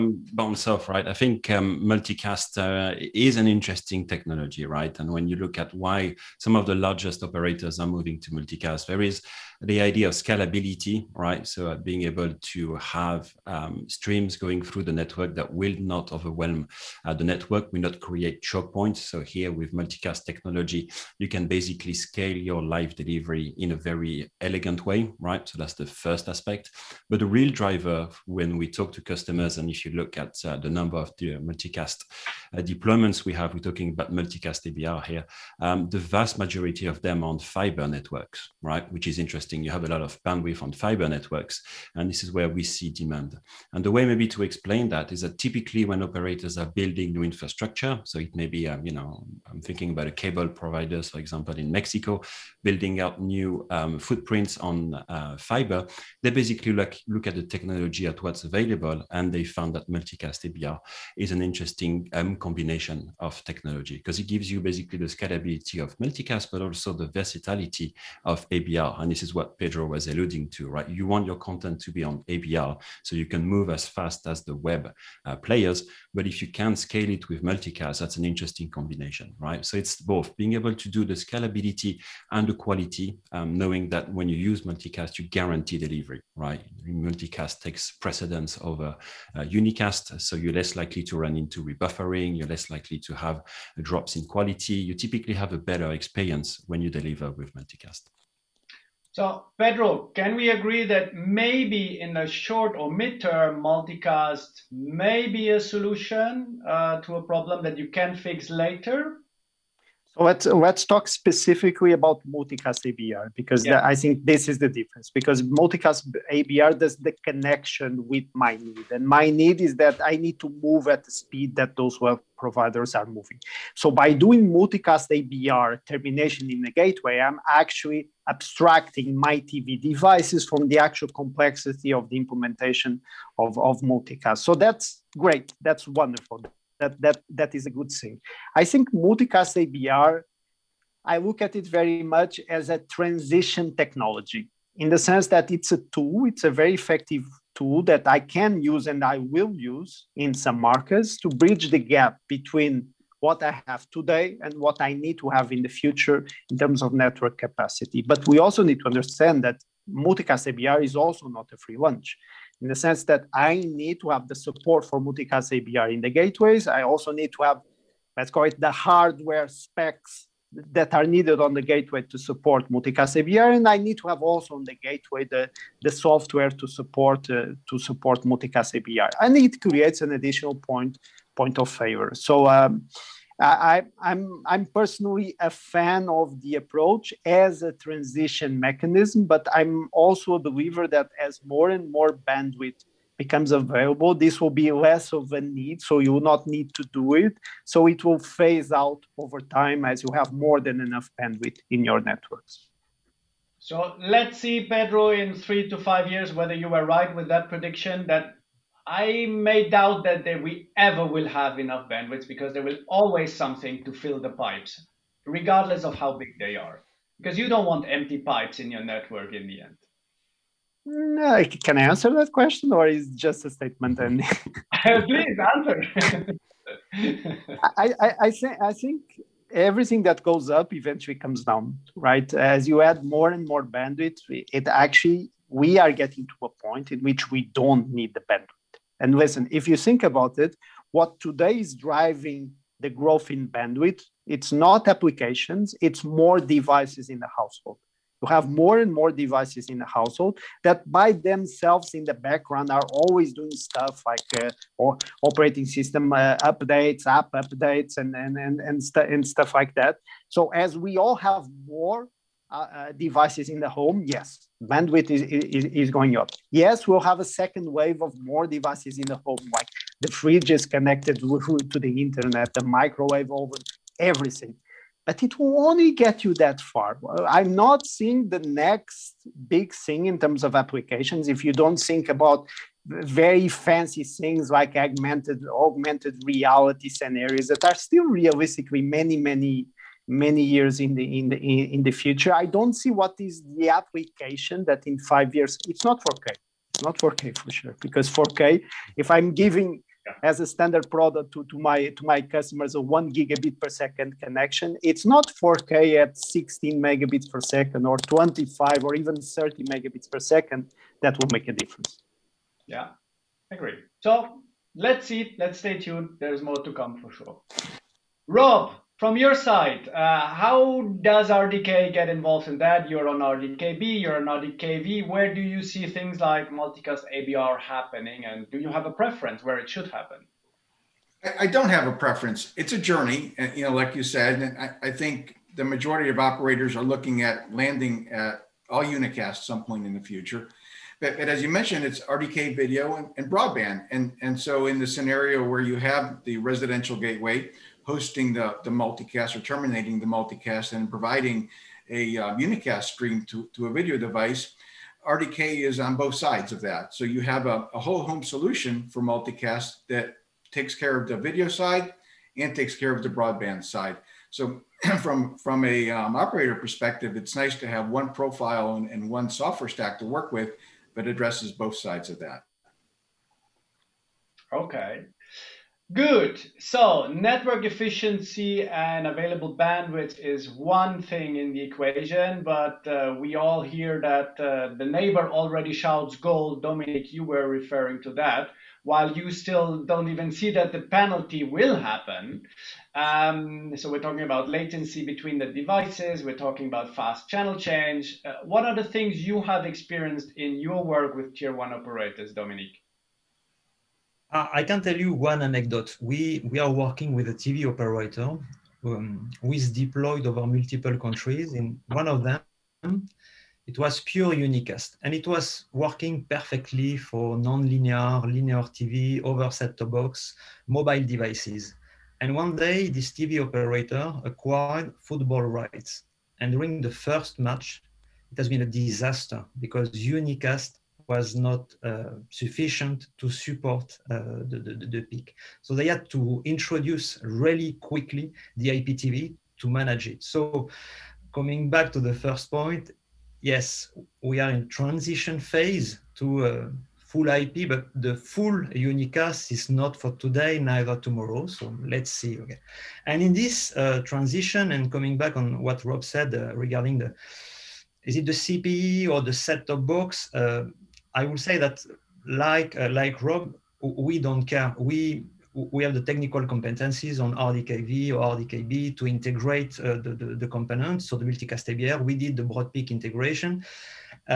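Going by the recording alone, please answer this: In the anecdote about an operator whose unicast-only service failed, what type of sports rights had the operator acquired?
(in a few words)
Football rights.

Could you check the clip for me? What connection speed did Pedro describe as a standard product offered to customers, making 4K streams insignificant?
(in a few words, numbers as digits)
1 gigabit per second.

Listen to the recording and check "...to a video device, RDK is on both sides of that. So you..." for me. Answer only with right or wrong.
right.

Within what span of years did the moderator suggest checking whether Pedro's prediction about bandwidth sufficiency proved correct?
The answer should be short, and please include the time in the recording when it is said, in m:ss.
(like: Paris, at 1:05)
3 to 5 years, at 3:25.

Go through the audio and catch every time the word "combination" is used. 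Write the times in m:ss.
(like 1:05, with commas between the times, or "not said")
1:02, 1:18.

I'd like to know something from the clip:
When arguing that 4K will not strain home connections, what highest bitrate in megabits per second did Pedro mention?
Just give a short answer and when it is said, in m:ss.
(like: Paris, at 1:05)
30 megabits per second, at 5:09.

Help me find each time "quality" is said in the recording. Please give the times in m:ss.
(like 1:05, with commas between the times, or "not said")
1:22, 1:34.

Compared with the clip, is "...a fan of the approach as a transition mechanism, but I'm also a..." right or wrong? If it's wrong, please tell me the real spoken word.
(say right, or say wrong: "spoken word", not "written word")
right.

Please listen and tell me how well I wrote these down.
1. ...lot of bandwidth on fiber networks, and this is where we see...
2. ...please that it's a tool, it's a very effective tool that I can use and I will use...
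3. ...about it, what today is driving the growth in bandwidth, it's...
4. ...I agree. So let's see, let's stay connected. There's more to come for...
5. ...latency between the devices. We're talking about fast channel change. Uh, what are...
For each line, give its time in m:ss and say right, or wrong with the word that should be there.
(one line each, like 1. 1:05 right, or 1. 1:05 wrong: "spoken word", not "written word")
1. 0:39 right
2. 2:24 wrong: "sense", not "please"
3. 4:00 right
4. 5:13 wrong: "tuned", not "connected"
5. 6:34 right.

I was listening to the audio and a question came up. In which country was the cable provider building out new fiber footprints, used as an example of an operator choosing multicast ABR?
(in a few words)
Mexico.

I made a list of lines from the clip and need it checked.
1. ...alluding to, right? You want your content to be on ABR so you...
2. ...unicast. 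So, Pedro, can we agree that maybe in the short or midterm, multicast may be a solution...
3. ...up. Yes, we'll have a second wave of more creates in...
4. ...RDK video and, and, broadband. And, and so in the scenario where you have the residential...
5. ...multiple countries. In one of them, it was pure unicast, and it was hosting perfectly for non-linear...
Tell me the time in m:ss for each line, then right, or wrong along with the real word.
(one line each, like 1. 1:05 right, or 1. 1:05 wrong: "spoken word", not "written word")
1. 1:10 right
2. 1:37 wrong: "multicast", not "unicast"
3. 4:26 wrong: "devices", not "creates"
4. 5:41 right
5. 6:50 wrong: "working", not "hosting".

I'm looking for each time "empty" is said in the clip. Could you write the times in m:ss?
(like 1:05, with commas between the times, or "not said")
3:37.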